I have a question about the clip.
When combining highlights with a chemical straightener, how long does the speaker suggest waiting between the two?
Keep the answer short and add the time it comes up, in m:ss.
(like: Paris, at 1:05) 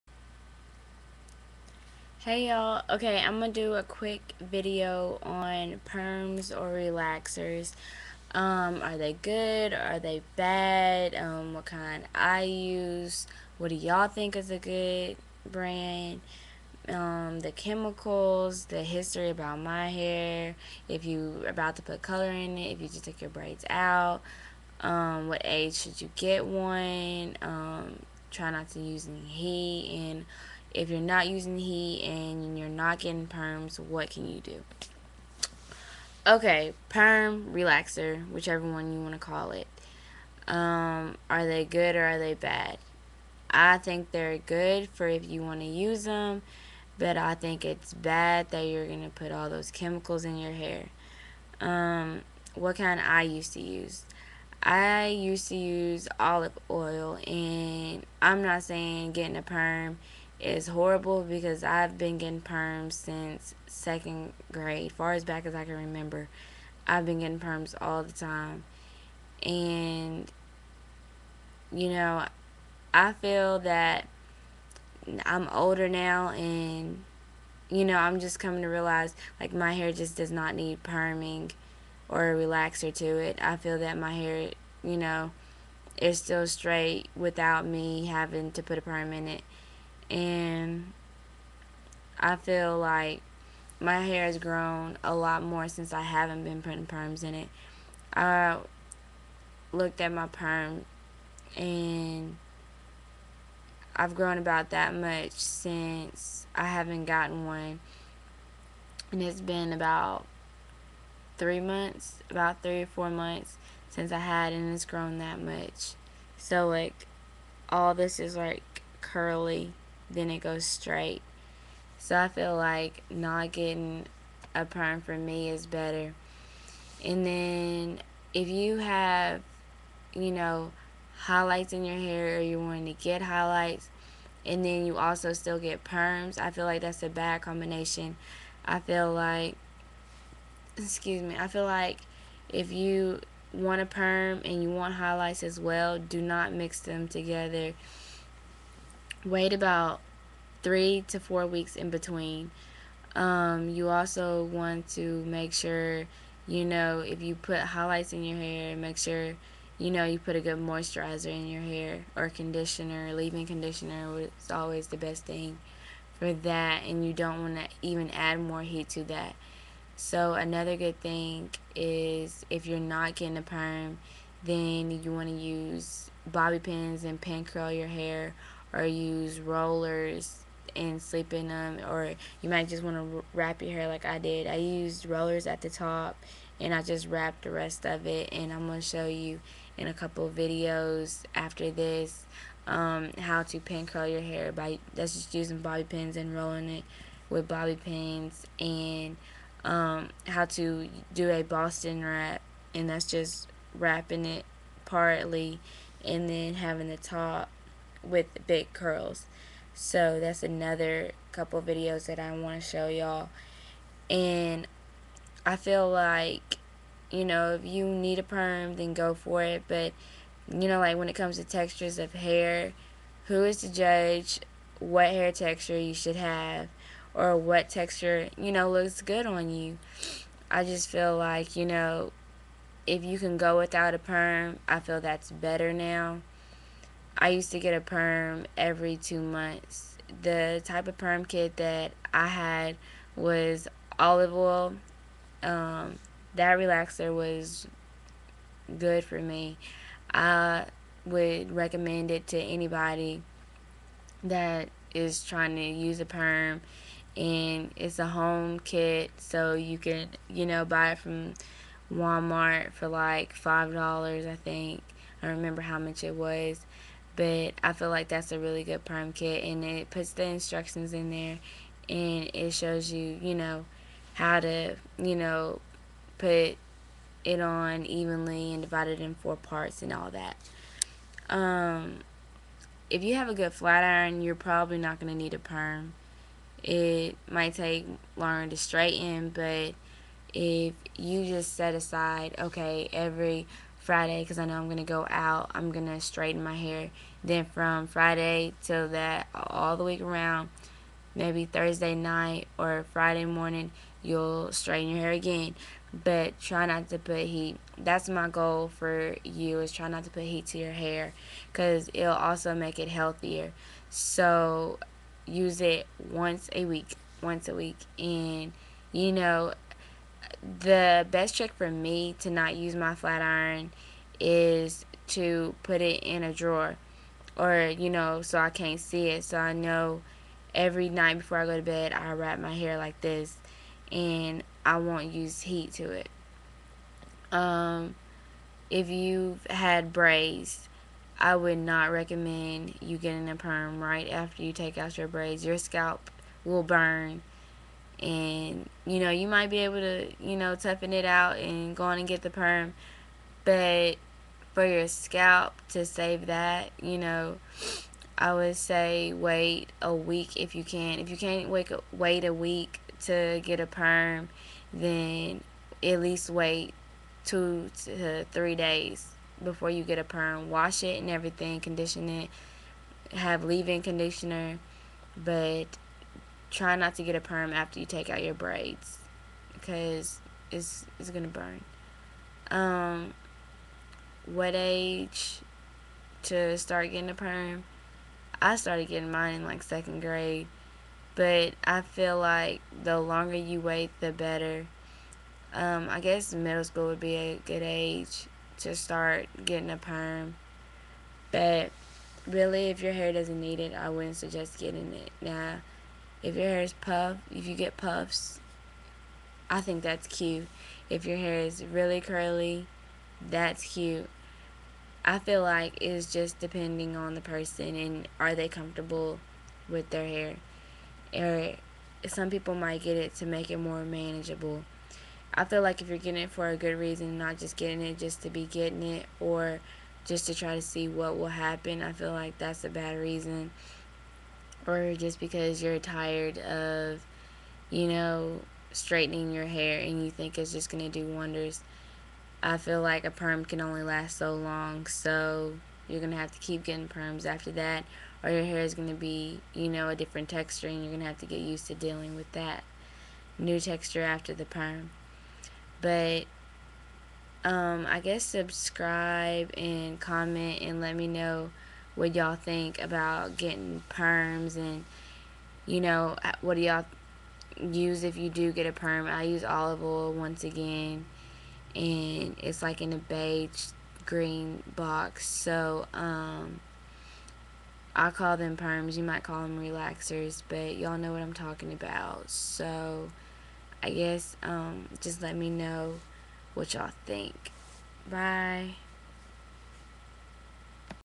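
3 to 4 weeks, at 2:30.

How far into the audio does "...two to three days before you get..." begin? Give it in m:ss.
6:07.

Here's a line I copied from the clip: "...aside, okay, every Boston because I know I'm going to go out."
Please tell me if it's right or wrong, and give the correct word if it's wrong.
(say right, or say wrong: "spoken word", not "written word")
wrong: "Friday", not "Boston".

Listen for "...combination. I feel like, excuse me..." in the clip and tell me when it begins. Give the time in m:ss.
2:17.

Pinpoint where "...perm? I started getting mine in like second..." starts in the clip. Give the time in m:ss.
6:27.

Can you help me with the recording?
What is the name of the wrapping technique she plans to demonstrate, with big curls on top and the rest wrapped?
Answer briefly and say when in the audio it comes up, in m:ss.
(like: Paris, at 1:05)
Boston wrap, at 3:21.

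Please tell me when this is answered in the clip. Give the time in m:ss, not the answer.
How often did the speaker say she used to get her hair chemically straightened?
3:58.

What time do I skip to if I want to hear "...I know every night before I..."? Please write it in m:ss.
5:29.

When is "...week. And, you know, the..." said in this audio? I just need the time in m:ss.
5:17.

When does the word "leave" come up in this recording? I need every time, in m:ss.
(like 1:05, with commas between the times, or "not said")
2:43, 6:13.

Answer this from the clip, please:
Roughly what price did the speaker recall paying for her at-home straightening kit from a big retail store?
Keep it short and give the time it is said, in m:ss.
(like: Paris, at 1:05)
5 dollars, at 4:23.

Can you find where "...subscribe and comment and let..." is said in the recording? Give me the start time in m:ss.
7:38.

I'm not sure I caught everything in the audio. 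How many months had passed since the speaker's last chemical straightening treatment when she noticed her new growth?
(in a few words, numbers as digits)
3 or 4 months.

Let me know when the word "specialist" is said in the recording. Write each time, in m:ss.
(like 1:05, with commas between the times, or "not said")
not said.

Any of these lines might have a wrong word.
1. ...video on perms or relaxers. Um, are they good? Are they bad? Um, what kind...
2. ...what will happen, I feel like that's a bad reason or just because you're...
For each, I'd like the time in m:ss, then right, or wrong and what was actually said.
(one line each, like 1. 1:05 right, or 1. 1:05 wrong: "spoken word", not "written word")
1. 0:04 right
2. 7:10 right.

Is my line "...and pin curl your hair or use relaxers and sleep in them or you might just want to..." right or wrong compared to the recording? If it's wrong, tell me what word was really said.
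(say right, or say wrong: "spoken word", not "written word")
wrong: "rollers", not "relaxers".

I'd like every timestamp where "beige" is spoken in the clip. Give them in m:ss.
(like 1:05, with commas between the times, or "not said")
7:52.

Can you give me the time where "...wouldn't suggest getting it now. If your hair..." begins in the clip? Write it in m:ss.
6:43.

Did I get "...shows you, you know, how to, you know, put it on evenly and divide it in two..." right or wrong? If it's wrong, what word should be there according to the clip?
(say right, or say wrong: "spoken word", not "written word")
wrong: "four", not "two".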